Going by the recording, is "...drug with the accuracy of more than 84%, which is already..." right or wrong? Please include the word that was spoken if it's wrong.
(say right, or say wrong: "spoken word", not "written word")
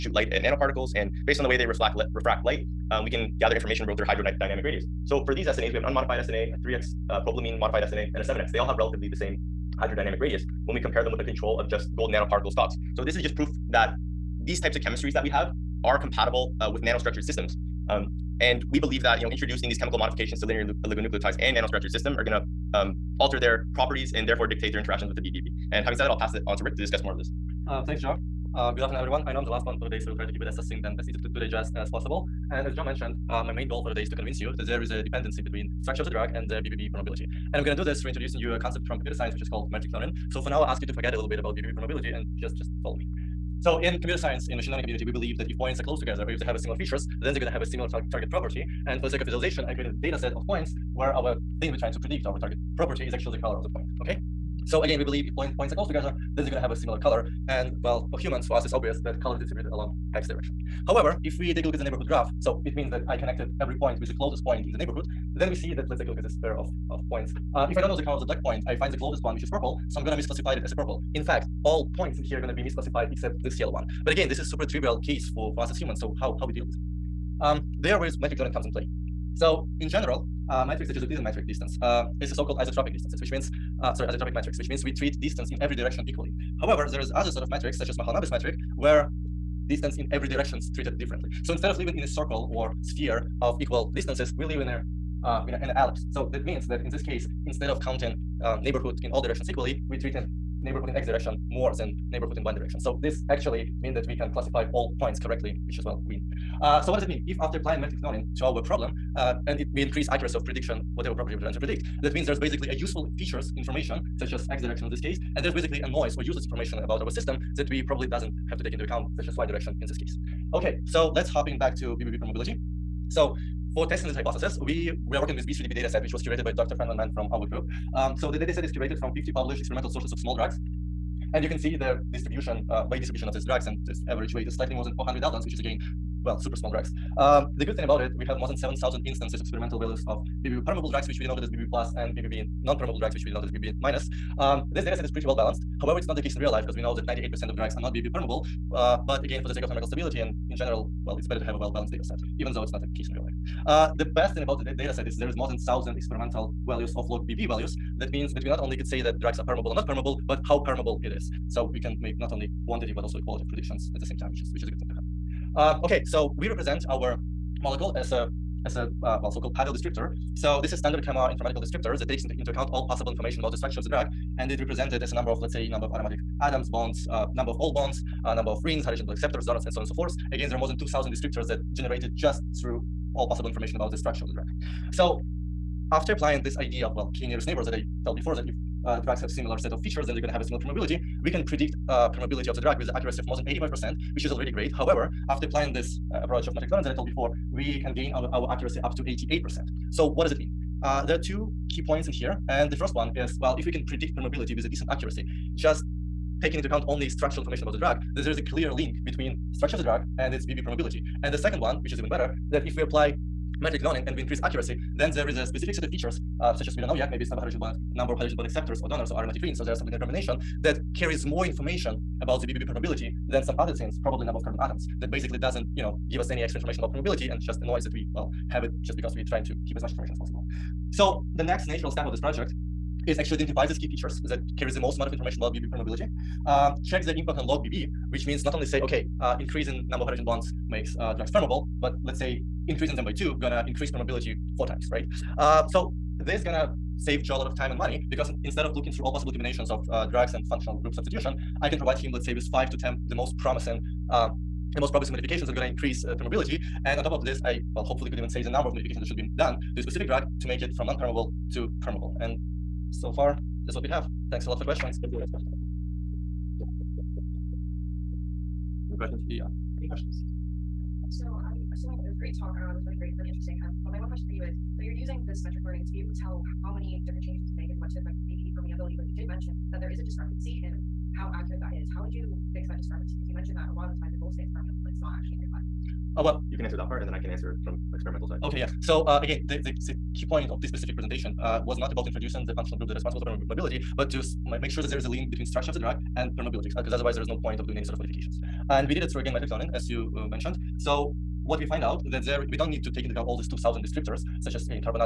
wrong: "85", not "84".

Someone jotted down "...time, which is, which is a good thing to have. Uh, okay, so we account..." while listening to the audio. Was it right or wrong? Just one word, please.
wrong.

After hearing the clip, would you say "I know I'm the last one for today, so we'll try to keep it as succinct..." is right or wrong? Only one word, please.
right.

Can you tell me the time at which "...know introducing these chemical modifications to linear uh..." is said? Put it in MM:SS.
00:19.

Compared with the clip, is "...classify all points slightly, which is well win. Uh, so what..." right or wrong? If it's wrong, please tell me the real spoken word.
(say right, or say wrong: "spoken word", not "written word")
wrong: "correctly", not "slightly".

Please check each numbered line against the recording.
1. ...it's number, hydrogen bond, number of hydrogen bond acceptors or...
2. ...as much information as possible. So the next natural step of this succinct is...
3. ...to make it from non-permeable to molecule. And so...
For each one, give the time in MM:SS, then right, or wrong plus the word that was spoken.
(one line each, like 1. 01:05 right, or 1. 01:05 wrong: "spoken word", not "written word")
1. 03:37 right
2. 03:49 wrong: "project", not "succinct"
3. 04:20 wrong: "permeable", not "molecule".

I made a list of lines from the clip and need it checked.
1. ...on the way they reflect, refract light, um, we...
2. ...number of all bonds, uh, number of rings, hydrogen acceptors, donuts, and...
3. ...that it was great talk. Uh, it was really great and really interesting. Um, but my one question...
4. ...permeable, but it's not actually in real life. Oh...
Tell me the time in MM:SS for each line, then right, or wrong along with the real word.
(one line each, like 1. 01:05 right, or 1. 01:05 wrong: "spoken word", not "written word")
1. 00:01 right
2. 02:57 right
3. 04:31 right
4. 04:44 right.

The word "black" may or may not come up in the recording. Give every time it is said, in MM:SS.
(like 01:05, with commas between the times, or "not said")
01:08.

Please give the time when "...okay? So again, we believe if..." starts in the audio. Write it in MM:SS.
00:54.